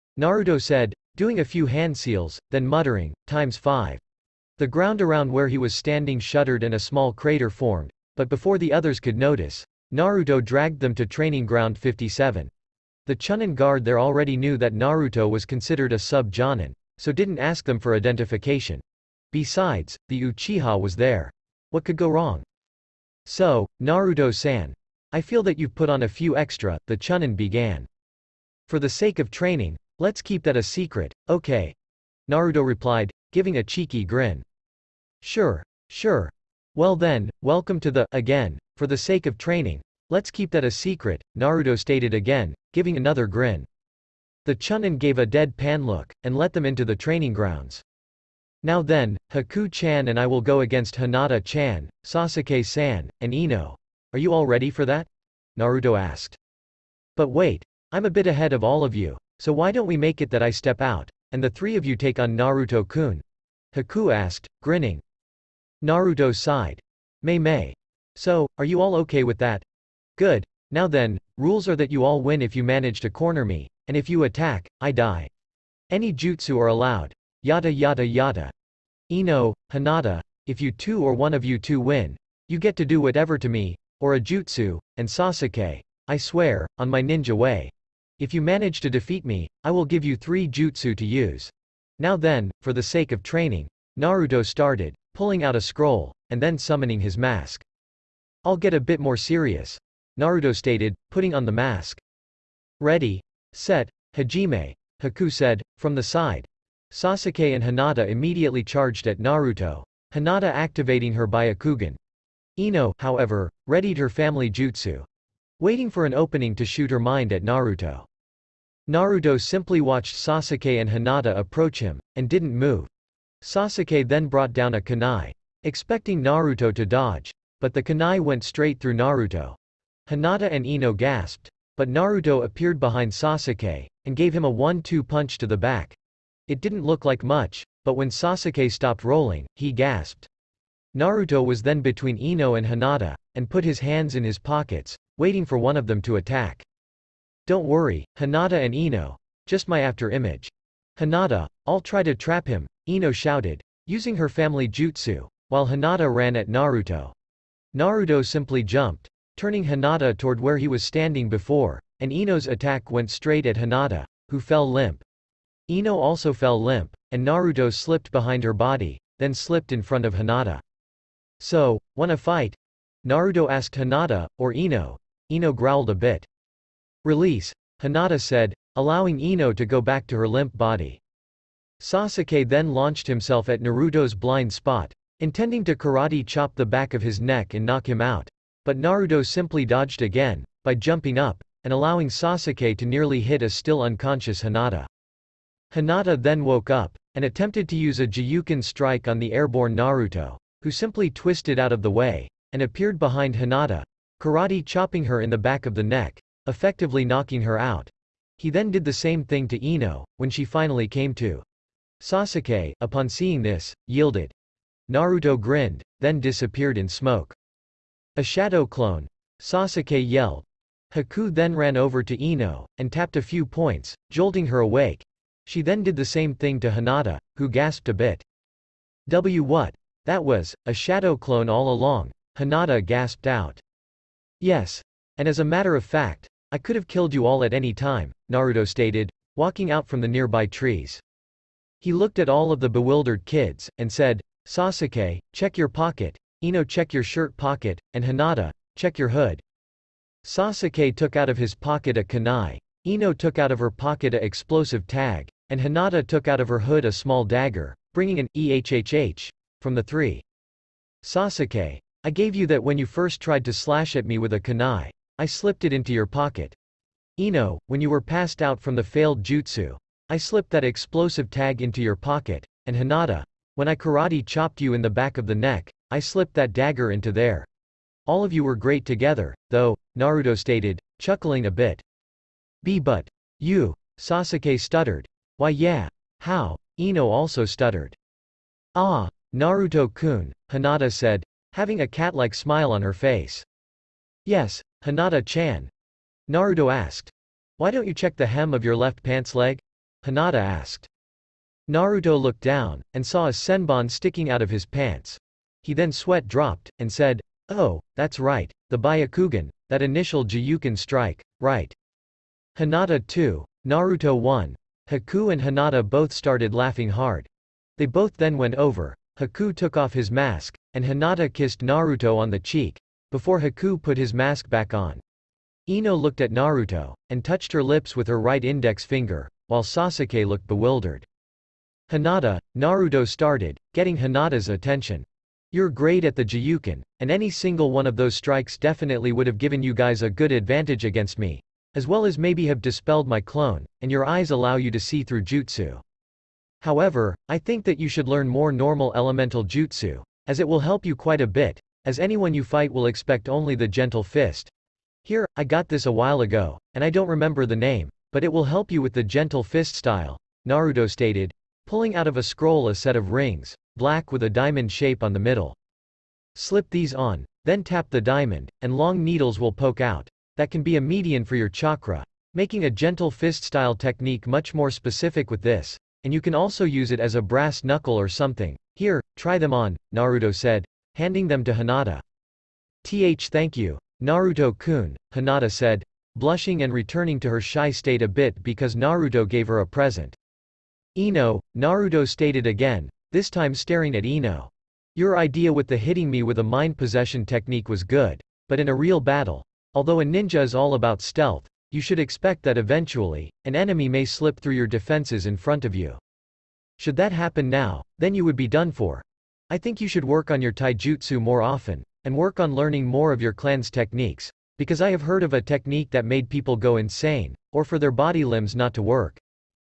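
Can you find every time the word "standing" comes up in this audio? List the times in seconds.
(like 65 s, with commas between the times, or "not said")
5 s, 160 s.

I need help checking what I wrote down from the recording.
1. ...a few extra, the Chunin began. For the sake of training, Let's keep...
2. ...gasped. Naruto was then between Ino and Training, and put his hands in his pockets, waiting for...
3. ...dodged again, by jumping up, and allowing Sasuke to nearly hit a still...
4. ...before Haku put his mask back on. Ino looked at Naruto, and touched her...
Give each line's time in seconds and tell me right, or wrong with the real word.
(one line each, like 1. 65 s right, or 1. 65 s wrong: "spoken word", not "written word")
1. 26 s right
2. 139 s wrong: "Hinata", not "Training"
3. 189 s right
4. 323 s right.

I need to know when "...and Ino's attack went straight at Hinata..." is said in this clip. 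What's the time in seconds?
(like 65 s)
162 s.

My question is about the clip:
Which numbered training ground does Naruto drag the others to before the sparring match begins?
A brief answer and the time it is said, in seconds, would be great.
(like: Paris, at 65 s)
57, at 11 s.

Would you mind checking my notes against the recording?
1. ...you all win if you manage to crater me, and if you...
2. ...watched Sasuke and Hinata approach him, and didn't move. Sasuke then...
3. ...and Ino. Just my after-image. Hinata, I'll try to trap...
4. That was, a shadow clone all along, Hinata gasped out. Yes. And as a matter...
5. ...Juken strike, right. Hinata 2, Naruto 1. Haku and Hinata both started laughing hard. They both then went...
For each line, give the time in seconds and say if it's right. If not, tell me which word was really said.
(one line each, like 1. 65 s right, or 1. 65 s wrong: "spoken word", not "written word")
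1. 71 s wrong: "corner", not "crater"
2. 119 s right
3. 148 s right
4. 230 s right
5. 310 s right.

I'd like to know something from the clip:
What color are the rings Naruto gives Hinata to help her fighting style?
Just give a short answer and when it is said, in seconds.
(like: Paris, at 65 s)
black, at 363 s.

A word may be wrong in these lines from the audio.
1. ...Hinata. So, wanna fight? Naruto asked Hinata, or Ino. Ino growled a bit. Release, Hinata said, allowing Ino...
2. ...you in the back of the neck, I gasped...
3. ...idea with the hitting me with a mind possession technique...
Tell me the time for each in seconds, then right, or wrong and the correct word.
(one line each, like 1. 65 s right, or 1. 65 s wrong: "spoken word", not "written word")
1. 170 s right
2. 274 s wrong: "slipped", not "gasped"
3. 395 s right.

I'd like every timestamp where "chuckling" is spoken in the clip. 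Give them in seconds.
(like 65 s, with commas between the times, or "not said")
280 s.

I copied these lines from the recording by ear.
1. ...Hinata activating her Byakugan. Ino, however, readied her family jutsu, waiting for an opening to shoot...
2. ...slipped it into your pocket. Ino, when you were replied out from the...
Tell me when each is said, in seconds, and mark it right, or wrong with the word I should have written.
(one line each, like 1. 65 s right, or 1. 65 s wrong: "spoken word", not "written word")
1. 110 s right
2. 265 s wrong: "passed", not "replied".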